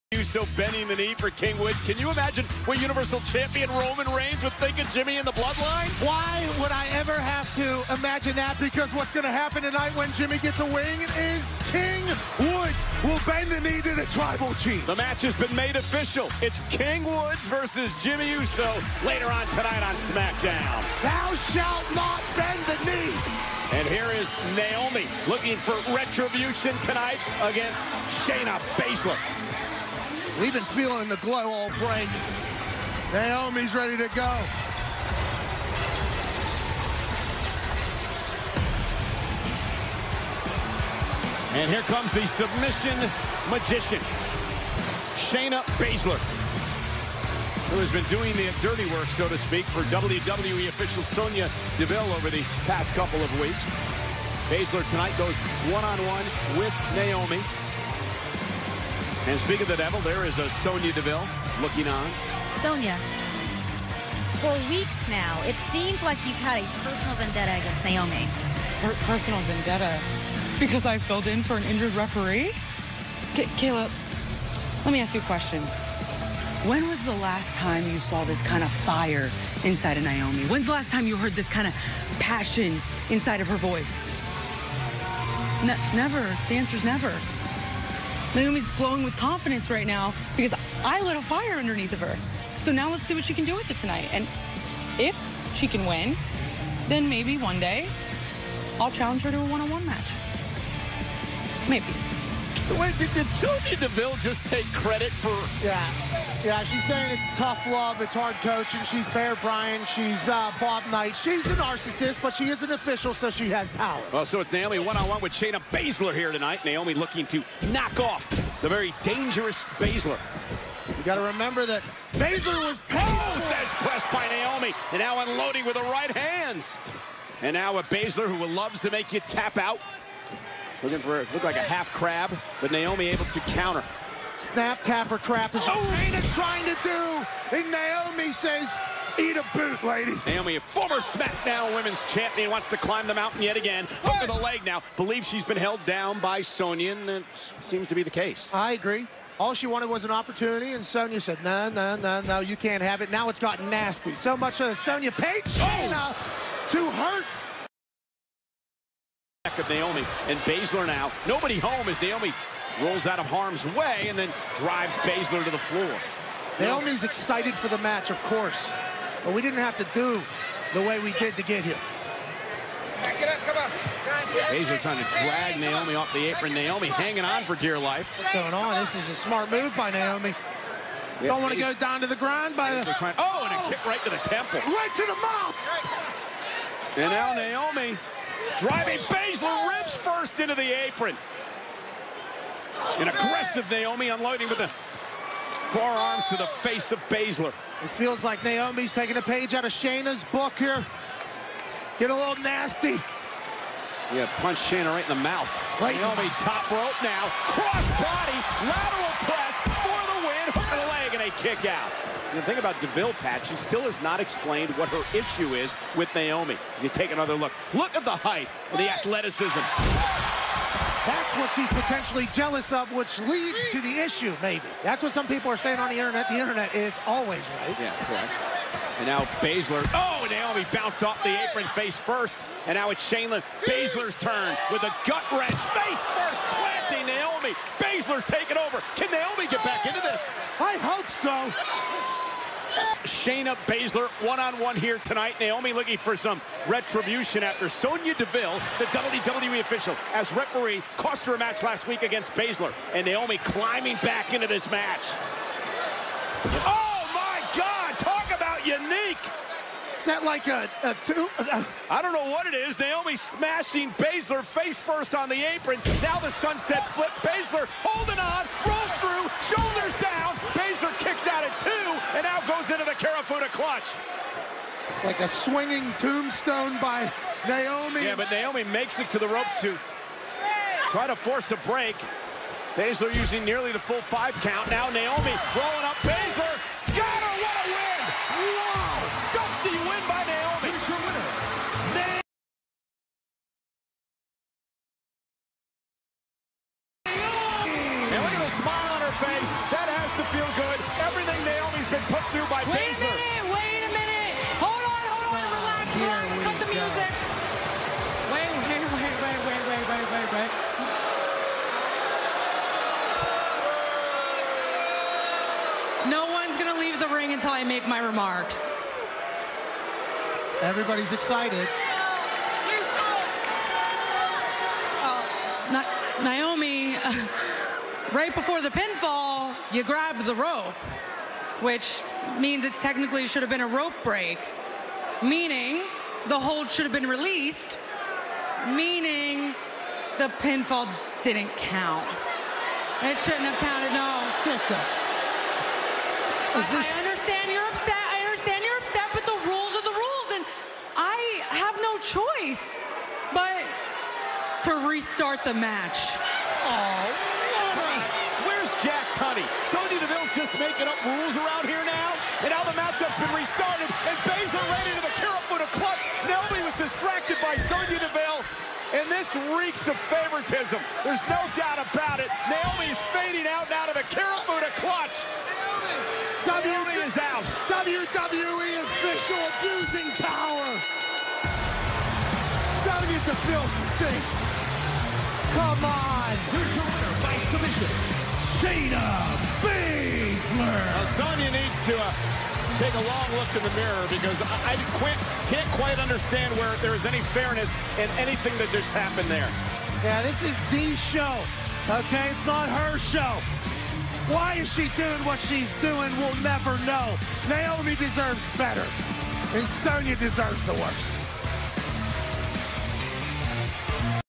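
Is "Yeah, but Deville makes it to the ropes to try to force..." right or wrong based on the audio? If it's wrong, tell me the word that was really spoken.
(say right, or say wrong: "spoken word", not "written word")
wrong: "Naomi", not "Deville".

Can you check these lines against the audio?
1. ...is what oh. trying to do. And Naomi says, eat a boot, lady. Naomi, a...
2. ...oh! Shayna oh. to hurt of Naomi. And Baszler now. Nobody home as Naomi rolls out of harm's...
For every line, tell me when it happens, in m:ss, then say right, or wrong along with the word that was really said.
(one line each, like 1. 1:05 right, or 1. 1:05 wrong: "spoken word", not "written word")
1. 2:15 right
2. 2:35 right.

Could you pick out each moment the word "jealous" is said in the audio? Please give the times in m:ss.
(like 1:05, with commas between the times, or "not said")
3:42.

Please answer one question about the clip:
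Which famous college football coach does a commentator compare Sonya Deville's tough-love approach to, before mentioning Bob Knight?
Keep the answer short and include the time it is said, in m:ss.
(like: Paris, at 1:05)
Bear Bryant, at 1:49.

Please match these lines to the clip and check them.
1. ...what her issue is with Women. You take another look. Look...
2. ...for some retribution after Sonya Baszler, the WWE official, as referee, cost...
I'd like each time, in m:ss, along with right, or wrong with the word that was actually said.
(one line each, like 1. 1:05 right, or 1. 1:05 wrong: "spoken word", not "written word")
1. 3:34 wrong: "Naomi", not "Women"
2. 4:05 wrong: "Deville", not "Baszler".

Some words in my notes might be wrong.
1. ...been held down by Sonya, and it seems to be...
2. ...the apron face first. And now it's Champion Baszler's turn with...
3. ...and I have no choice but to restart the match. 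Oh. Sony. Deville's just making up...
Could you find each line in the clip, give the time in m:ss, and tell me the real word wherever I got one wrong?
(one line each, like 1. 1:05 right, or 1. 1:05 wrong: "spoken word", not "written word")
1. 2:25 right
2. 3:51 wrong: "Shayna", not "Champion"
3. 5:50 right.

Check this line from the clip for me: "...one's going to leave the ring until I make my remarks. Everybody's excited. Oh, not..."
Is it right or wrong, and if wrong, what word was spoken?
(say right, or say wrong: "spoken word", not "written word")
right.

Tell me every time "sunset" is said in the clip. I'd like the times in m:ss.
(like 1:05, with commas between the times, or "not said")
4:26.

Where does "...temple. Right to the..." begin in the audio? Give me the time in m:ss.
3:04.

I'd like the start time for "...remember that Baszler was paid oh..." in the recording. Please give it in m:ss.
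2:01.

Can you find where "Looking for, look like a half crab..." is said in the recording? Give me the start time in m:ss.
2:10.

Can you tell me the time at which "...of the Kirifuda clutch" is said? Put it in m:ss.
6:13.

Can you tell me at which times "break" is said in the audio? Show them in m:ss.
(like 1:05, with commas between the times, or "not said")
0:31, 4:41, 5:34.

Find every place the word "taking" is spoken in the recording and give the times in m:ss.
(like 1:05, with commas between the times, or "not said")
3:18, 3:58.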